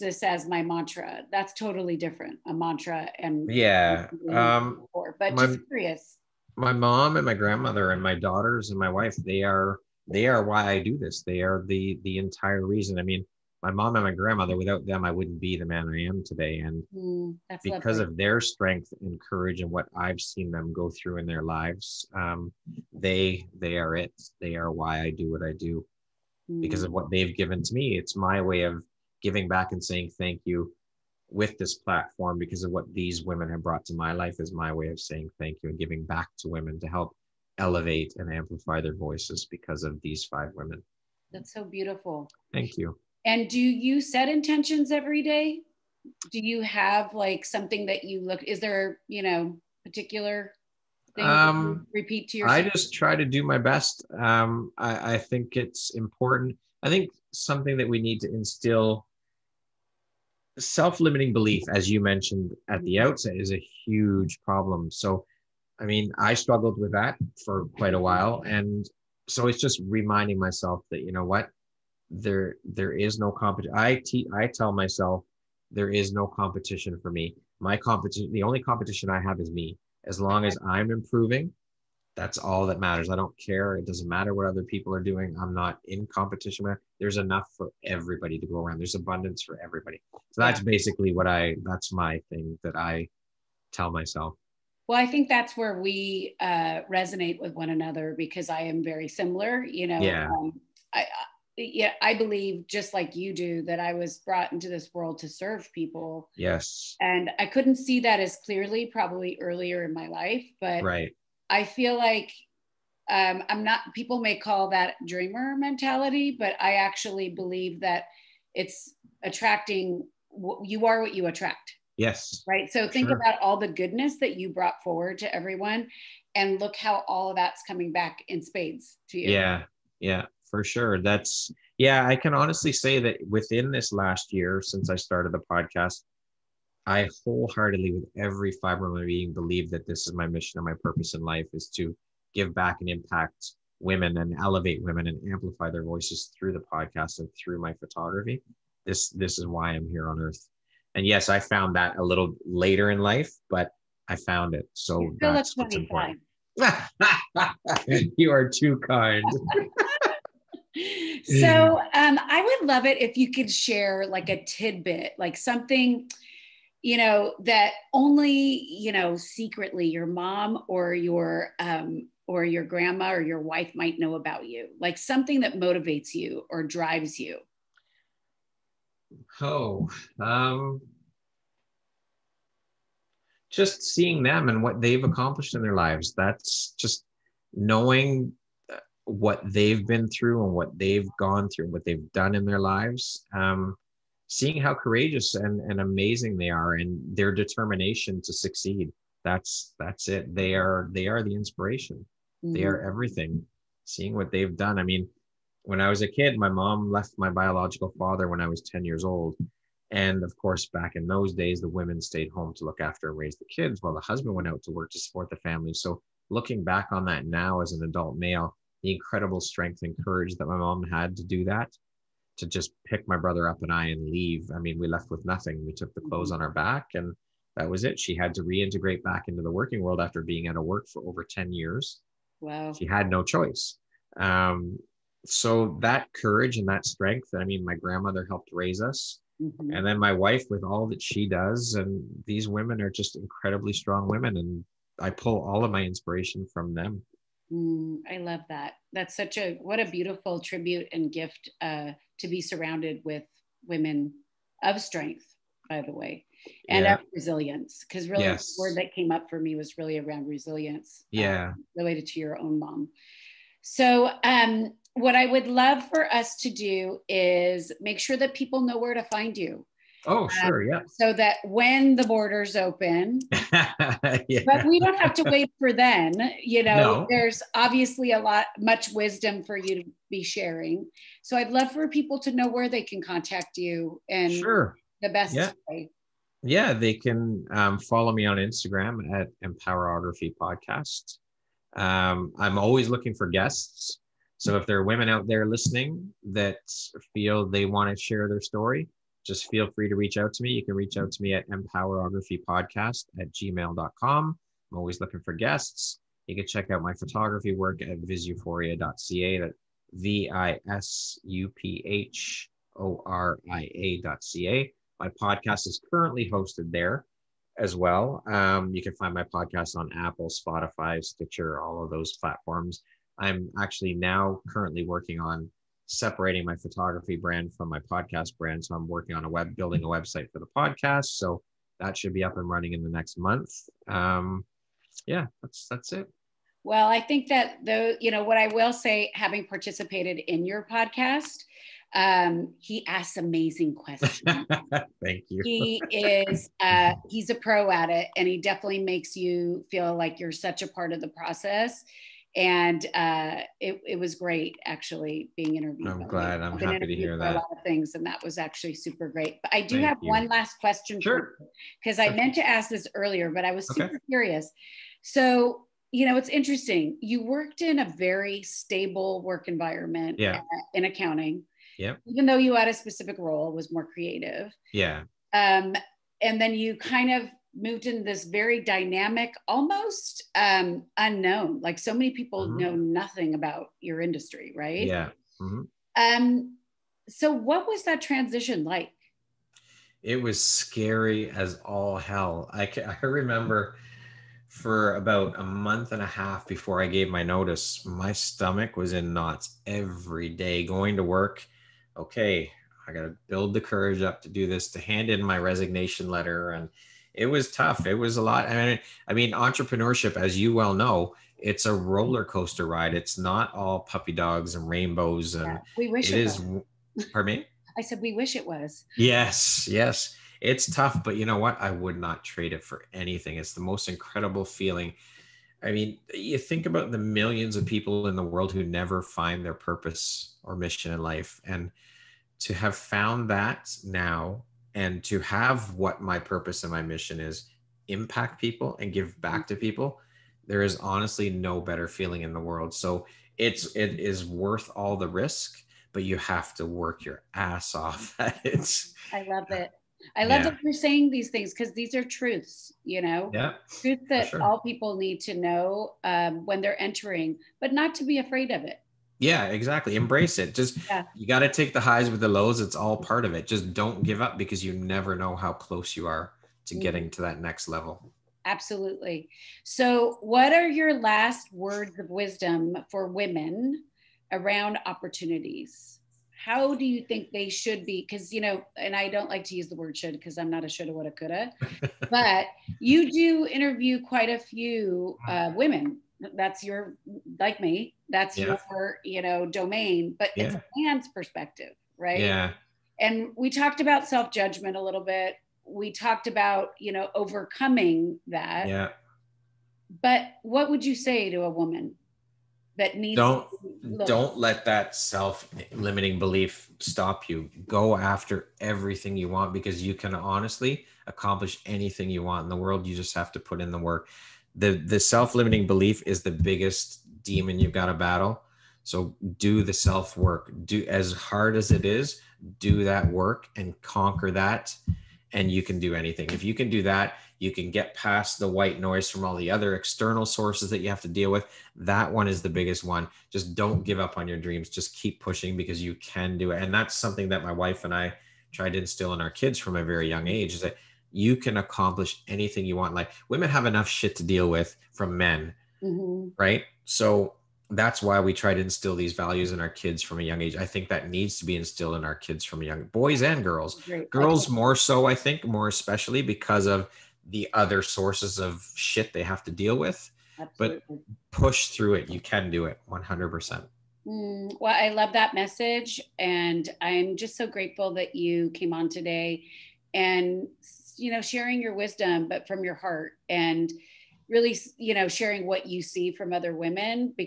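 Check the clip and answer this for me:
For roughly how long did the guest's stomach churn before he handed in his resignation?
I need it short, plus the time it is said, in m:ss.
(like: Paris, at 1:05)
a month and a half, at 6:35.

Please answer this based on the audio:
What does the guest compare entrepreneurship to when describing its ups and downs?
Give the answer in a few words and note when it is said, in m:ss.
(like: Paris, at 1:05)
roller coaster ride, at 6:51.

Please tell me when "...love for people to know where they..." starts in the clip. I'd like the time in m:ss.
4:41.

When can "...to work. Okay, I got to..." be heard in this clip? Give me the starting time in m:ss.
6:40.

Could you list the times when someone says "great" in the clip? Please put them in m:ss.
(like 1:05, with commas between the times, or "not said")
5:54, 5:59.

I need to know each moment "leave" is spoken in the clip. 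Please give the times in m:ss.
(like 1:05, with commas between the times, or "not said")
3:44.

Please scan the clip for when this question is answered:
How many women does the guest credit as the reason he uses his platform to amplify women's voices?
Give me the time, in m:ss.
0:40.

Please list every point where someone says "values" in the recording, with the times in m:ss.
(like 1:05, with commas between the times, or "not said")
9:09.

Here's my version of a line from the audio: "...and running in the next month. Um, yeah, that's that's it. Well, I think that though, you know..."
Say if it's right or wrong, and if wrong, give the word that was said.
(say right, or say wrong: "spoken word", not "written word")
right.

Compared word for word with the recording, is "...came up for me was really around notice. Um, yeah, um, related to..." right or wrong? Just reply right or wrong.
wrong.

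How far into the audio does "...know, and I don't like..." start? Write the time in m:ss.
7:58.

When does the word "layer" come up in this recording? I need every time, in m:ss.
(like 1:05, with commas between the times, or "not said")
not said.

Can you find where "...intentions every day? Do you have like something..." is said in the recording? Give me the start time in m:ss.
0:44.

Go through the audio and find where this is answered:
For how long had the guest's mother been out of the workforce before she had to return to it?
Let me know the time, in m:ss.
3:51.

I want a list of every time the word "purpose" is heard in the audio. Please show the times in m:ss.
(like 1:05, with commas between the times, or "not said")
2:20, 7:09, 7:16.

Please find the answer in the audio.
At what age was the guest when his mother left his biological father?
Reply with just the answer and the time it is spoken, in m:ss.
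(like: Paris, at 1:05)
10, at 3:28.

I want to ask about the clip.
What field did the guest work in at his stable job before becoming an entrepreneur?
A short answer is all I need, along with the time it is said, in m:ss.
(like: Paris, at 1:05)
accounting, at 6:10.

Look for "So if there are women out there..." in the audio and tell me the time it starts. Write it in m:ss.
4:54.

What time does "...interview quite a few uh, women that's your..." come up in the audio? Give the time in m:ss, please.
8:03.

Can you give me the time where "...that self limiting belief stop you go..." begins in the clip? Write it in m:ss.
8:24.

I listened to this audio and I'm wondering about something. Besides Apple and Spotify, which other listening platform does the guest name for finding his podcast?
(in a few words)
Stitcher.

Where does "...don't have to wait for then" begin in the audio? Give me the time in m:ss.
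4:34.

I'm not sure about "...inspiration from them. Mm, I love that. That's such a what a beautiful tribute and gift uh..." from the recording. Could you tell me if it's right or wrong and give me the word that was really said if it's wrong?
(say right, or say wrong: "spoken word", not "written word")
right.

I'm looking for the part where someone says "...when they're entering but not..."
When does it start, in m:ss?
7:36.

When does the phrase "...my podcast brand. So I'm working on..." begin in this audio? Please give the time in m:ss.
5:27.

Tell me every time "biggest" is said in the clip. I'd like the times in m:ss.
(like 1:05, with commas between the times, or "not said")
8:36, 8:52.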